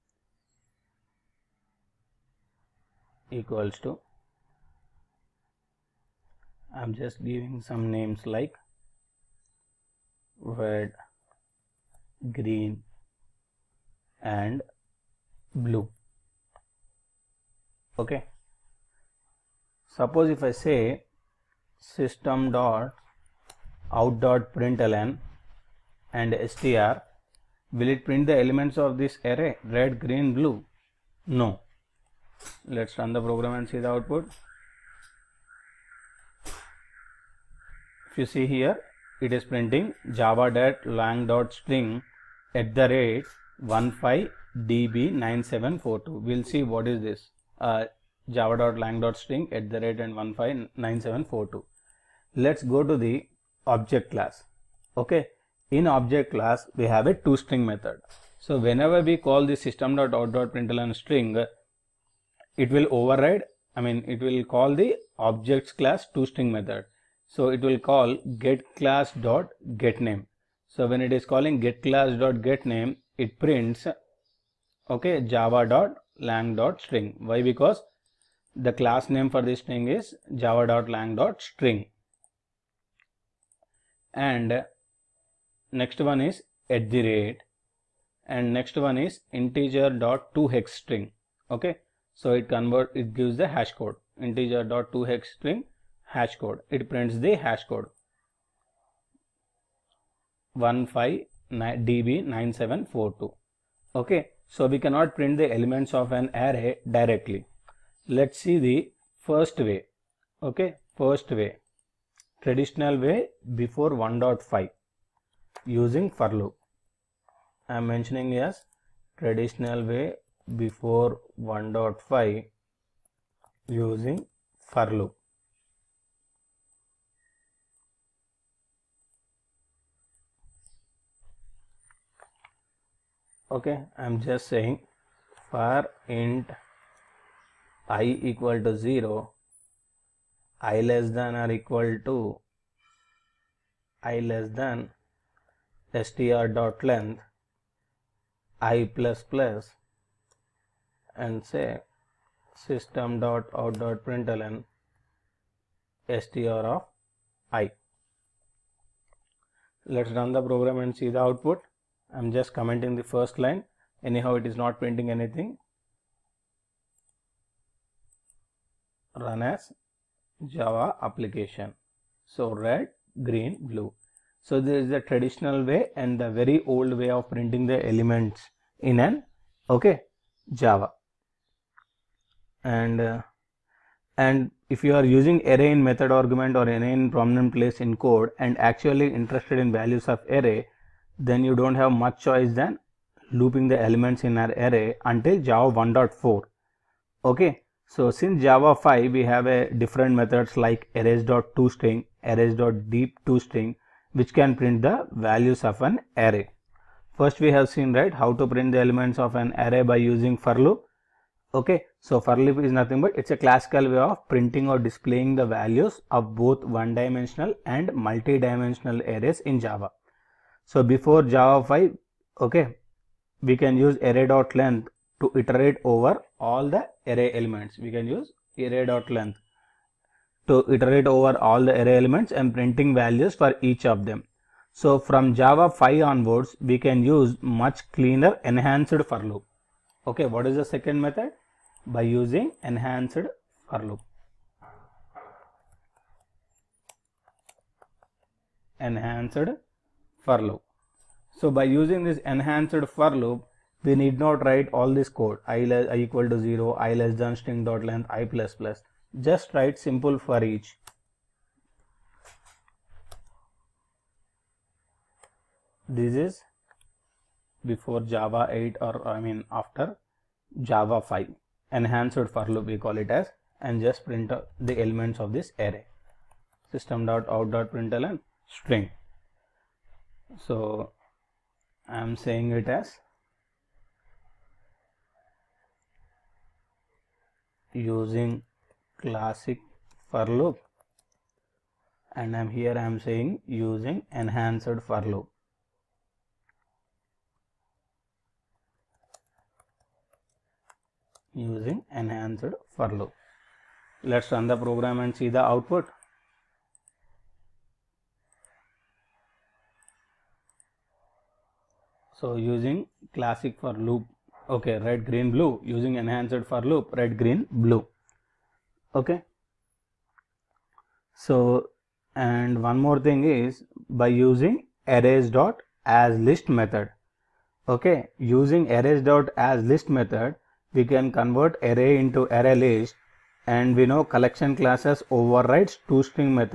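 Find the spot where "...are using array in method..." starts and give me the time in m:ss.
3:04.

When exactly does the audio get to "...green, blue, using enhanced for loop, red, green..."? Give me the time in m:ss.
5:15.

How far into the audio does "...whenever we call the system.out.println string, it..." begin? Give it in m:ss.
0:58.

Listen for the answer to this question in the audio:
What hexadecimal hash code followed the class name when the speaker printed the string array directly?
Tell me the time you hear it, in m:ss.
0:43.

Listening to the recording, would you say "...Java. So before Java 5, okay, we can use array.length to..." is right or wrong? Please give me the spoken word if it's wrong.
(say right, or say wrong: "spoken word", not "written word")
right.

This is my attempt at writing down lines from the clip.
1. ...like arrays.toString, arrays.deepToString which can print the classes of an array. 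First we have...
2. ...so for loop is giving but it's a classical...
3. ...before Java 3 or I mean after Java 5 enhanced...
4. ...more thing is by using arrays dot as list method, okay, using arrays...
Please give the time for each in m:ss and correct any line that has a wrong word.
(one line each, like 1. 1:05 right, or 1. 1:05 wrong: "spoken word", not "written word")
1. 3:20 wrong: "values", not "classes"
2. 3:31 wrong: "nothing", not "giving"
3. 4:27 wrong: "8", not "3"
4. 5:22 right.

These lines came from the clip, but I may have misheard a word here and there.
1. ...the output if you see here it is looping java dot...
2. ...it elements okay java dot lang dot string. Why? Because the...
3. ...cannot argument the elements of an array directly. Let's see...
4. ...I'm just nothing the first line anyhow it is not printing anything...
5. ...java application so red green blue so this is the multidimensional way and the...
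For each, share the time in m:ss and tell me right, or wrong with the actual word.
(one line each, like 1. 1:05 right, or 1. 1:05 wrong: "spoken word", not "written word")
1. 0:33 wrong: "printing", not "looping"
2. 1:13 wrong: "prints", not "elements"
3. 1:44 wrong: "print", not "argument"
4. 2:42 wrong: "commenting", not "nothing"
5. 2:50 wrong: "traditional", not "multidimensional".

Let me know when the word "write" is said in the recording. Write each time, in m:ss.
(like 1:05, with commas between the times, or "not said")
4:14, 4:19.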